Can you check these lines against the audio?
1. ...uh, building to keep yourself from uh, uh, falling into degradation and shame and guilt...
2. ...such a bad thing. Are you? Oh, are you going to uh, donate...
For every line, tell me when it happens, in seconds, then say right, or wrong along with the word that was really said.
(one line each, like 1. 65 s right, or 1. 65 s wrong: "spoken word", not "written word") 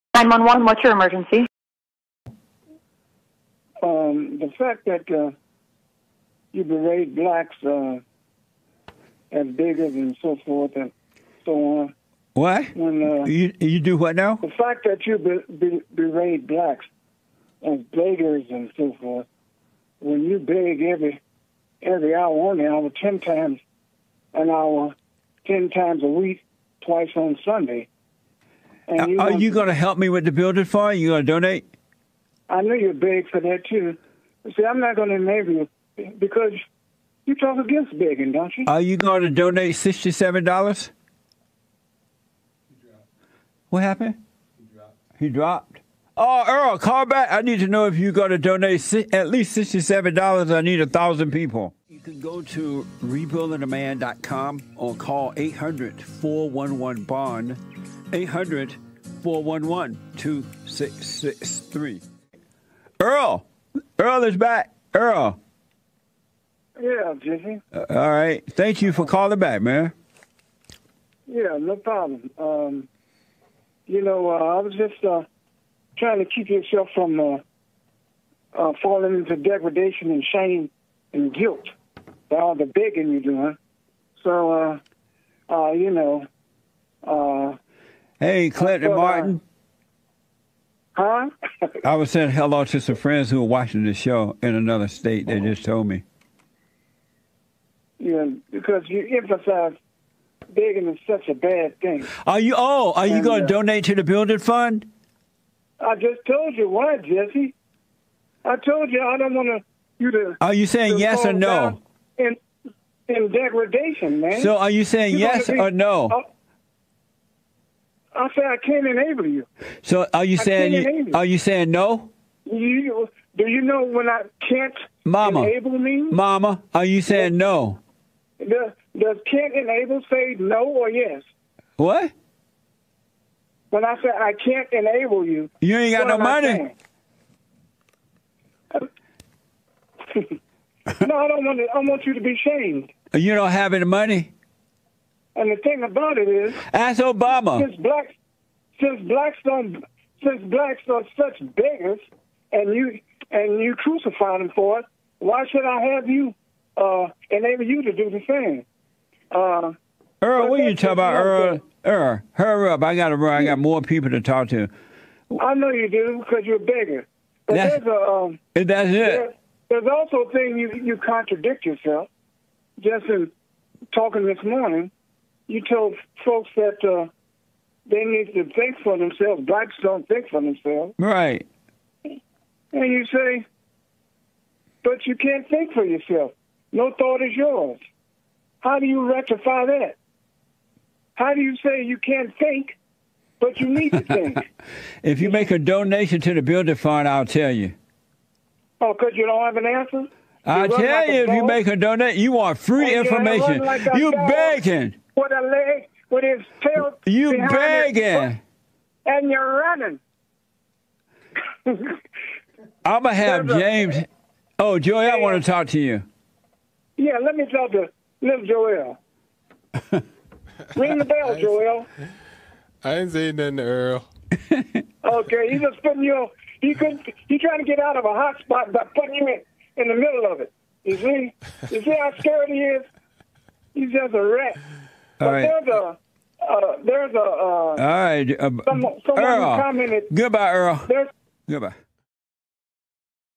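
1. 75 s wrong: "trying", not "building"
2. 101 s right.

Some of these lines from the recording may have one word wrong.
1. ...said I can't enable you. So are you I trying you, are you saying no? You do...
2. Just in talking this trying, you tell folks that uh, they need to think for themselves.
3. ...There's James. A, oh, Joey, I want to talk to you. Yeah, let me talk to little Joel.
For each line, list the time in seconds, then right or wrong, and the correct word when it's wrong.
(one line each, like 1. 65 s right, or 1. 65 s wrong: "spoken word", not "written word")
1. 118 s wrong: "saying", not "trying"
2. 172 s wrong: "morning", not "trying"
3. 213 s right.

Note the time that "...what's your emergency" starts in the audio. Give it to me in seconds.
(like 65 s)
0 s.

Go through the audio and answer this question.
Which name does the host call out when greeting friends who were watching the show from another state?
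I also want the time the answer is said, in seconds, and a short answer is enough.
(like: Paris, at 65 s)
Clinton Martin, at 88 s.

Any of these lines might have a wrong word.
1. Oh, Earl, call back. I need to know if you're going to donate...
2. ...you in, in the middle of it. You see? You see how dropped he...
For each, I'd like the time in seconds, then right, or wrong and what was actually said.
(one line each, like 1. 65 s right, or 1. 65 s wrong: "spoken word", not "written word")
1. 46 s right
2. 229 s wrong: "scared", not "dropped".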